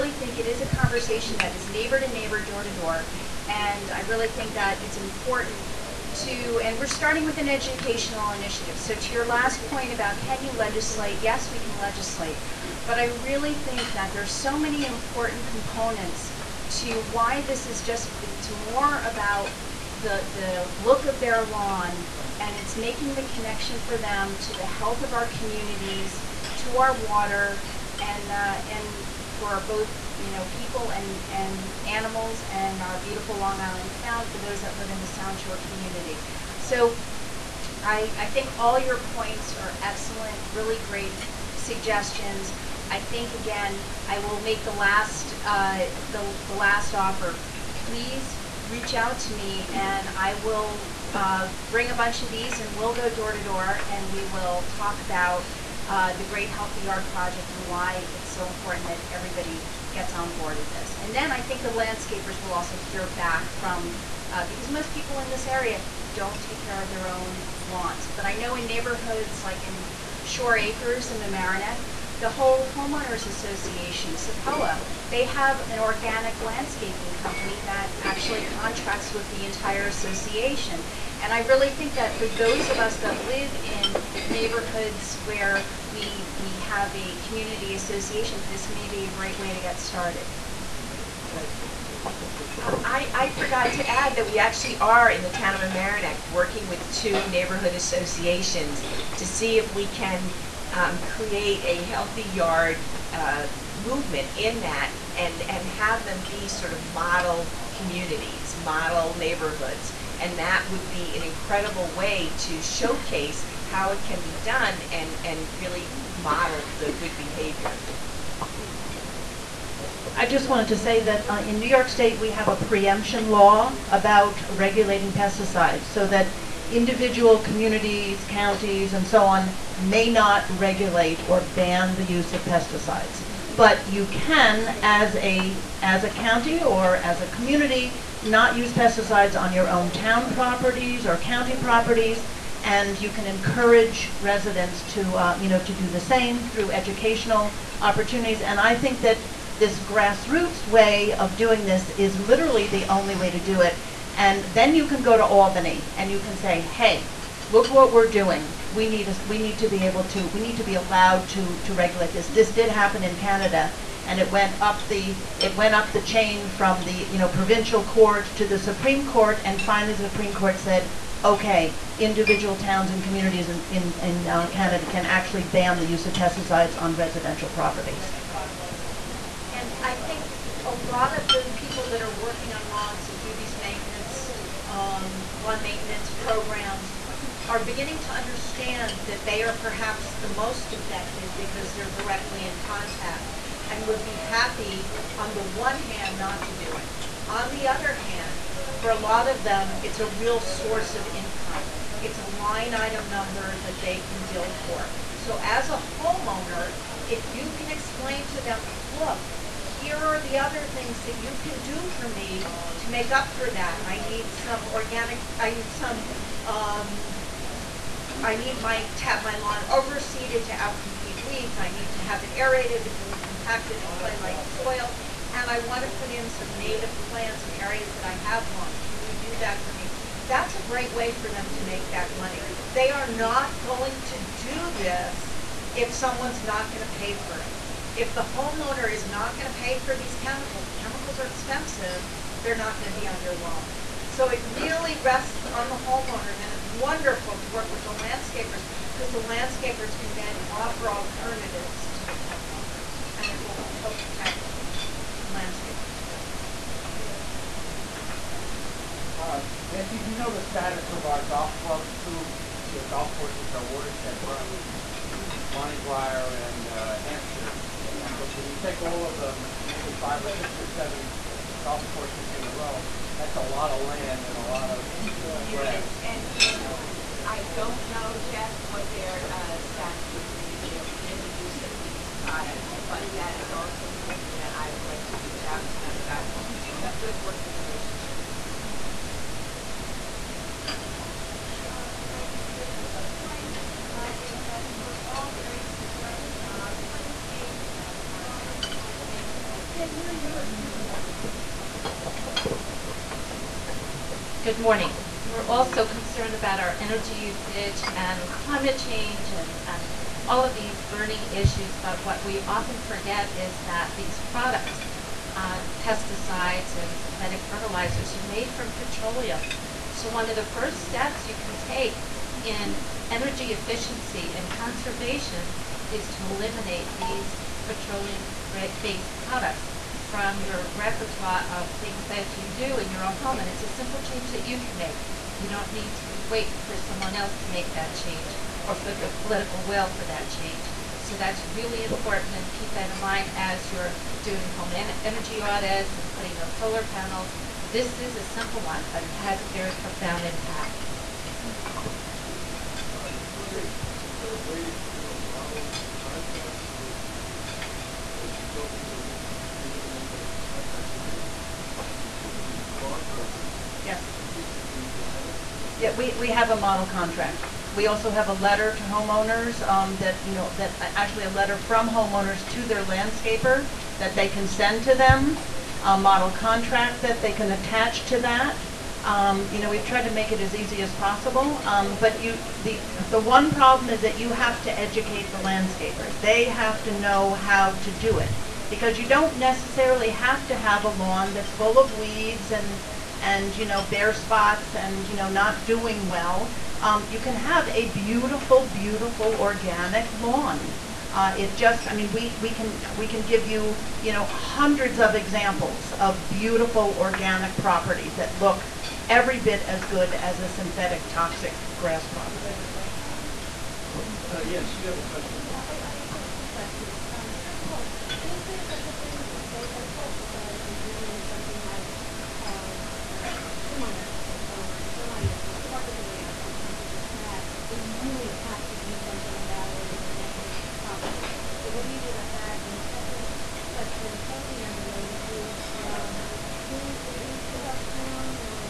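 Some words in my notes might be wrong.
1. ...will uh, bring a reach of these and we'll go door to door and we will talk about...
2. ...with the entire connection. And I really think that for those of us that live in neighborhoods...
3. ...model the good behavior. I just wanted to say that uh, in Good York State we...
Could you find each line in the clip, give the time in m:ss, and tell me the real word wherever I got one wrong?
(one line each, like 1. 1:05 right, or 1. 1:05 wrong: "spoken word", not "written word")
1. 0:50 wrong: "bunch", not "reach"
2. 1:19 wrong: "association", not "connection"
3. 1:56 wrong: "New", not "Good".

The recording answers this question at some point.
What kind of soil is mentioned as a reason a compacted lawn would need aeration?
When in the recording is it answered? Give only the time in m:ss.
3:43.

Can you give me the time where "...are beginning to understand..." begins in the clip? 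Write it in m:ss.
3:07.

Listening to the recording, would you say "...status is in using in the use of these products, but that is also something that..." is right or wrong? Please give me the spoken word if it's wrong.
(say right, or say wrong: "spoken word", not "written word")
right.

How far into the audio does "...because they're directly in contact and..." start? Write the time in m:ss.
3:11.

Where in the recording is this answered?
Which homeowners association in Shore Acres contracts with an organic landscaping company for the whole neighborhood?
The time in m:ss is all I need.
1:14.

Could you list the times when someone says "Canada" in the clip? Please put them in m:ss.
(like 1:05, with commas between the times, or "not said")
2:43, 2:54.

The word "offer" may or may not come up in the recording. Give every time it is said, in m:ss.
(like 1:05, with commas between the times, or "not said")
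0:46, 4:10.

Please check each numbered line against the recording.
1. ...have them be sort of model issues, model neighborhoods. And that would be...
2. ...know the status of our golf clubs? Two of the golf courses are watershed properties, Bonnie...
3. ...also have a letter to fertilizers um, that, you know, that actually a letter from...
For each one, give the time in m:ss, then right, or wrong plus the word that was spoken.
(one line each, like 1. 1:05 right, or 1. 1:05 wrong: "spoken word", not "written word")
1. 1:45 wrong: "communities", not "issues"
2. 4:20 right
3. 6:07 wrong: "homeowners", not "fertilizers".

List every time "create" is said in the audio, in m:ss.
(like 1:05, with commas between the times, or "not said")
1:40.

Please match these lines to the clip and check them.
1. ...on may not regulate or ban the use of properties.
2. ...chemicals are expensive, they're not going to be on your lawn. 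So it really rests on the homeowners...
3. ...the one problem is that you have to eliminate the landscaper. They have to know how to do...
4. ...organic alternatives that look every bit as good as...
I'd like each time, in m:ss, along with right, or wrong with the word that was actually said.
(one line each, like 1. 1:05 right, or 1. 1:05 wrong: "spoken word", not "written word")
1. 2:09 wrong: "pesticides", not "properties"
2. 4:00 right
3. 6:23 wrong: "educate", not "eliminate"
4. 6:46 wrong: "properties", not "alternatives".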